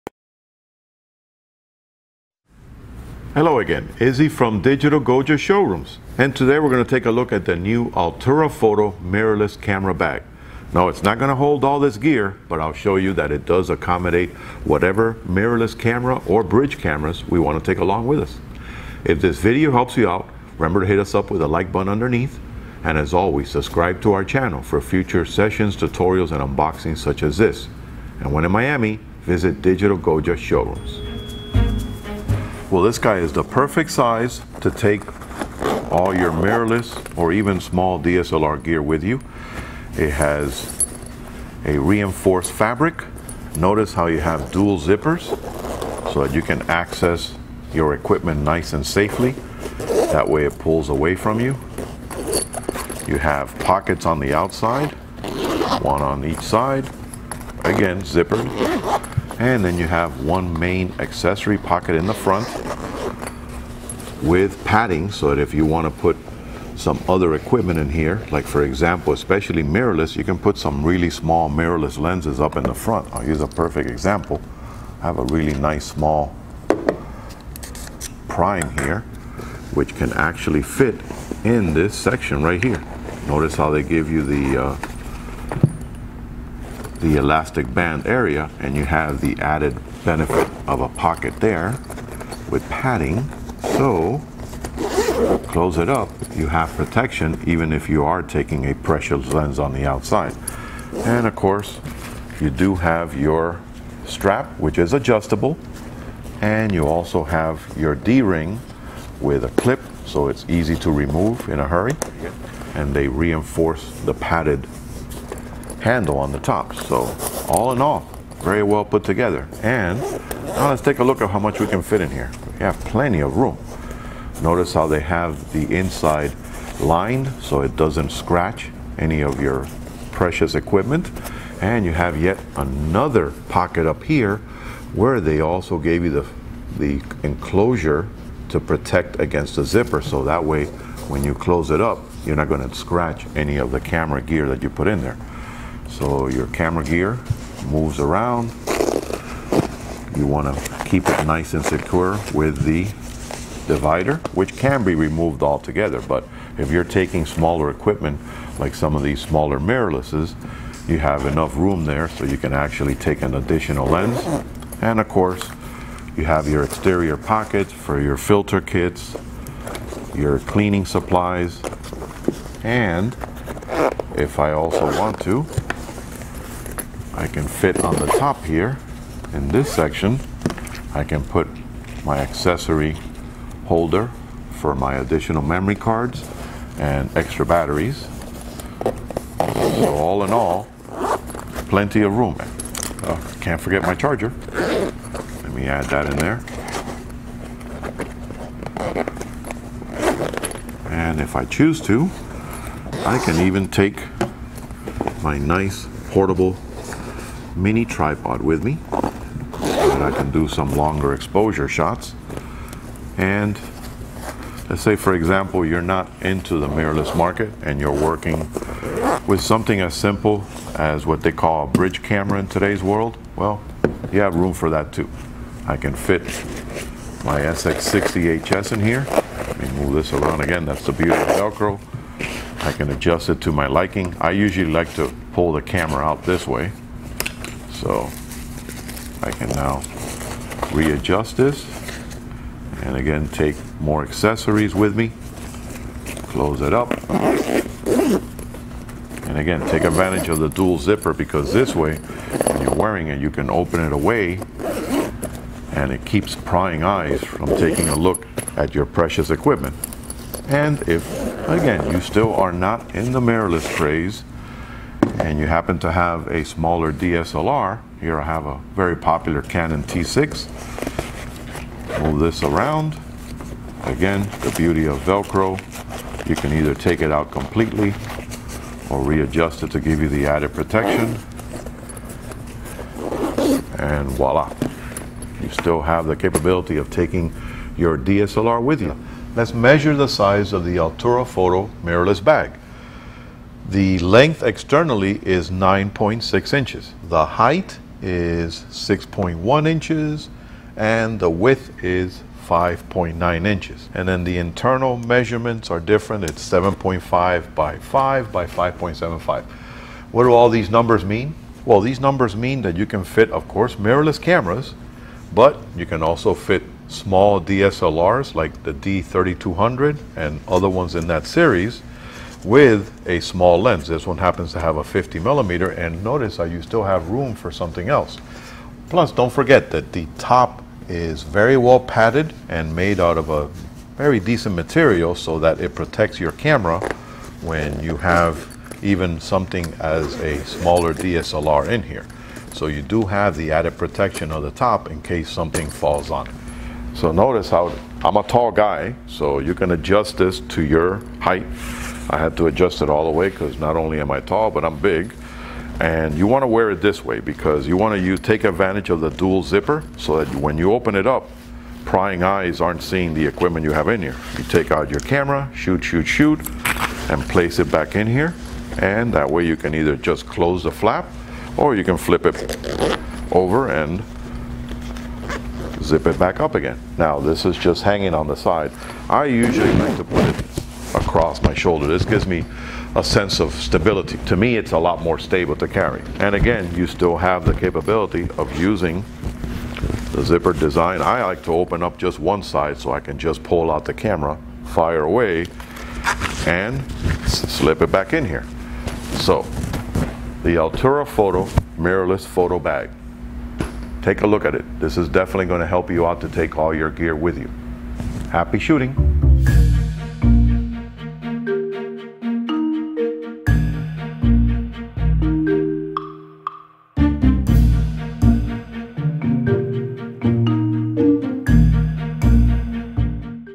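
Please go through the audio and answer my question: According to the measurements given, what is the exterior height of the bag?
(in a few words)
6.1 inches.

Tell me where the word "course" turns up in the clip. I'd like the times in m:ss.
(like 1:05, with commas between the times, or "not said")
1:41, 2:45, 5:13.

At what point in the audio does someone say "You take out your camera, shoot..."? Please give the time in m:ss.
6:04.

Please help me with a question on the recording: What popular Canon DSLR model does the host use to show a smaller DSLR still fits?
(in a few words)
Canon T6.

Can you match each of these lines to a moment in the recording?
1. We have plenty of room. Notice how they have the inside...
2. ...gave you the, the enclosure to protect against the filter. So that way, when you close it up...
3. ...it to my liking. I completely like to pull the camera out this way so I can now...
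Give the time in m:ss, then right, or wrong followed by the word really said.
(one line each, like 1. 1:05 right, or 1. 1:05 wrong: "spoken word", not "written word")
1. 2:02 right
2. 2:15 wrong: "zipper", not "filter"
3. 3:53 wrong: "usually", not "completely".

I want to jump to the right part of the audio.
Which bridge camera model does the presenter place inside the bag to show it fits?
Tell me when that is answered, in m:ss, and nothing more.
3:47.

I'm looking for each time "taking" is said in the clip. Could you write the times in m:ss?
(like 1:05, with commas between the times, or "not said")
1:38, 2:36, 4:17, 4:46.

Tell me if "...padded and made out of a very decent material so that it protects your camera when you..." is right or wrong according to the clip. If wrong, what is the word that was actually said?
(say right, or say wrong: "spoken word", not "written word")
right.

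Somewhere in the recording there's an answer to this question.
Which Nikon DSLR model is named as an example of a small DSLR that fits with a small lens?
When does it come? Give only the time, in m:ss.
5:18.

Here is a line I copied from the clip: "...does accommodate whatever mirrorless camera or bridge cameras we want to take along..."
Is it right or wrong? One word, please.
right.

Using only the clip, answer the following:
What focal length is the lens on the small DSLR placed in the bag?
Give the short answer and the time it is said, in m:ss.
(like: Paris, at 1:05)
50 millimeter, at 5:24.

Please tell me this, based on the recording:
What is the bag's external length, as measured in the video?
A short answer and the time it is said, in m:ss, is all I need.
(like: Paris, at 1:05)
9.6 inches, at 4:55.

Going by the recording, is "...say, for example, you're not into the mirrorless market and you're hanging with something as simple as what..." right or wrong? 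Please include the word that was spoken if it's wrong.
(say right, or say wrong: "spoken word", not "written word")
wrong: "working", not "hanging".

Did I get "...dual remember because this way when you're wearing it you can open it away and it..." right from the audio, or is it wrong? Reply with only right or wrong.
wrong.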